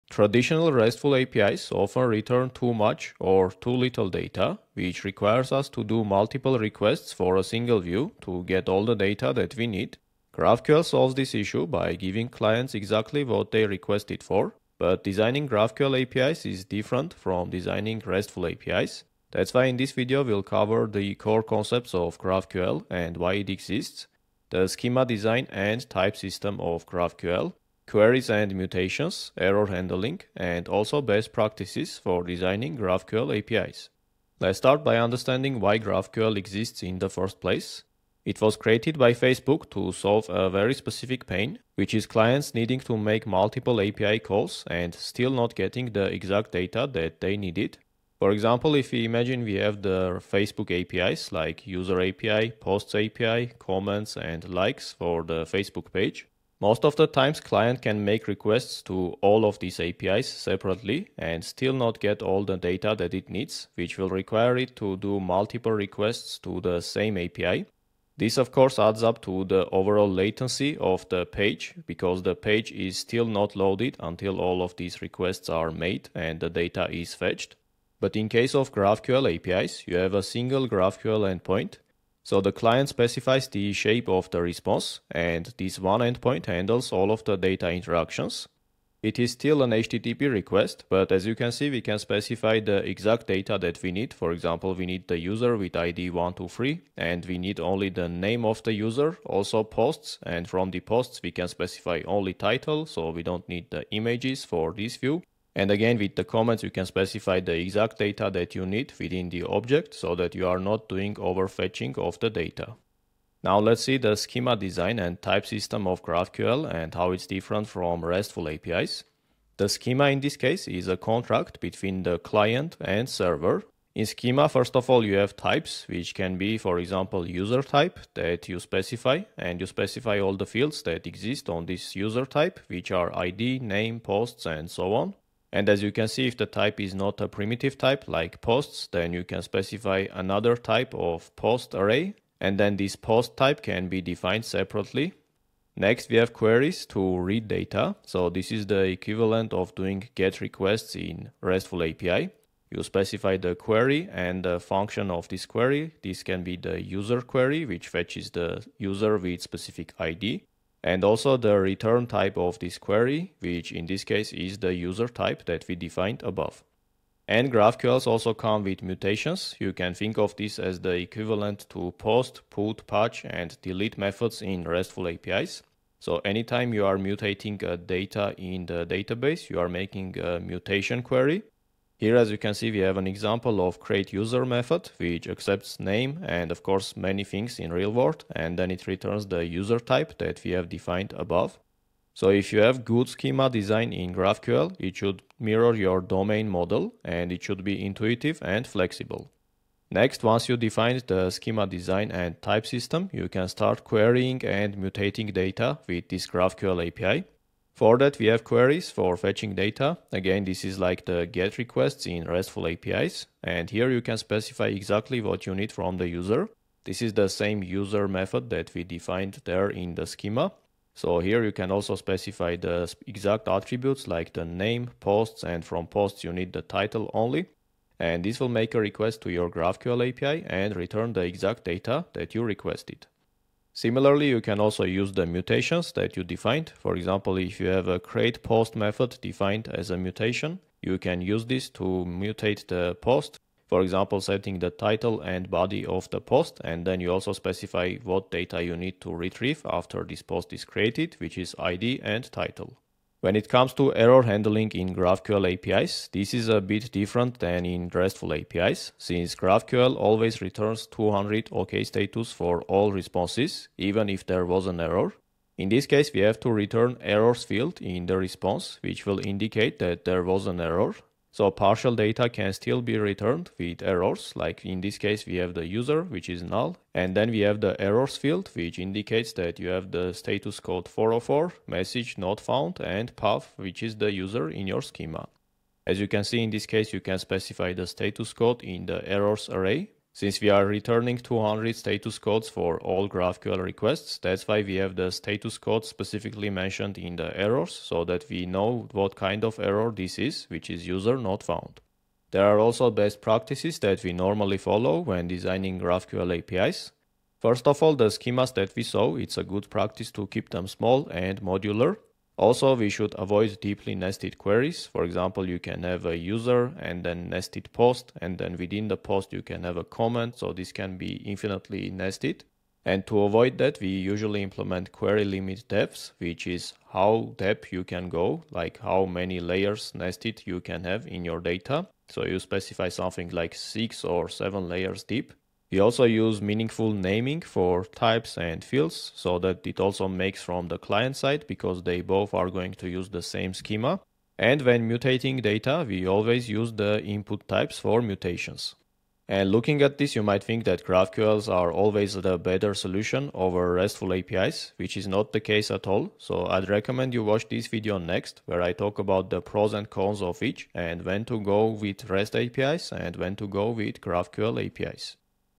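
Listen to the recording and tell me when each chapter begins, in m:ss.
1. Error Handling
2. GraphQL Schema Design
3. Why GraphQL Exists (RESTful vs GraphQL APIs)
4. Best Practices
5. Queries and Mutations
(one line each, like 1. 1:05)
1. 4:17
2. 1:53
3. 0:34
4. 5:02
5. 3:22.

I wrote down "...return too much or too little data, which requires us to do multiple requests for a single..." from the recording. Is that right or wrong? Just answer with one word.
right.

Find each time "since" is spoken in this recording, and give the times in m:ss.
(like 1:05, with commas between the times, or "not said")
4:18, 4:50.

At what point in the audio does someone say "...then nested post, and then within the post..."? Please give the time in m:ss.
5:17.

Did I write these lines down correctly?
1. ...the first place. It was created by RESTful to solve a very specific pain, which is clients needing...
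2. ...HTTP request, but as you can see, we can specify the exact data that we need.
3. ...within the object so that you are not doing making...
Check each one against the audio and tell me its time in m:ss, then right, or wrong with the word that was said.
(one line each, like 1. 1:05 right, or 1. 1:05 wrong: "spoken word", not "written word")
1. 0:36 wrong: "Facebook", not "RESTful"
2. 1:29 right
3. 1:48 wrong: "overfetching", not "making".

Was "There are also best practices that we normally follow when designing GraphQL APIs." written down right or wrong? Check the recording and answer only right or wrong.
right.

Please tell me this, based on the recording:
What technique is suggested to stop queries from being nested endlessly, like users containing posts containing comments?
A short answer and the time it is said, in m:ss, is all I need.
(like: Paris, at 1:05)
query limit depths, at 5:24.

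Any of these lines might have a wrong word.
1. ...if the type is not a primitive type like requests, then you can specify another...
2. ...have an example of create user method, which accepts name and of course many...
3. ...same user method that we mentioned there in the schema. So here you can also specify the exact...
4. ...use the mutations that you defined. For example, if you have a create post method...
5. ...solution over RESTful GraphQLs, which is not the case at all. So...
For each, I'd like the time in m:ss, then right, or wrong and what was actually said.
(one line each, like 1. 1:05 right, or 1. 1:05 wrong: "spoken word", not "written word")
1. 2:16 wrong: "posts", not "requests"
2. 3:02 right
3. 3:37 wrong: "defined", not "mentioned"
4. 3:54 right
5. 5:52 wrong: "APIs", not "GraphQLs".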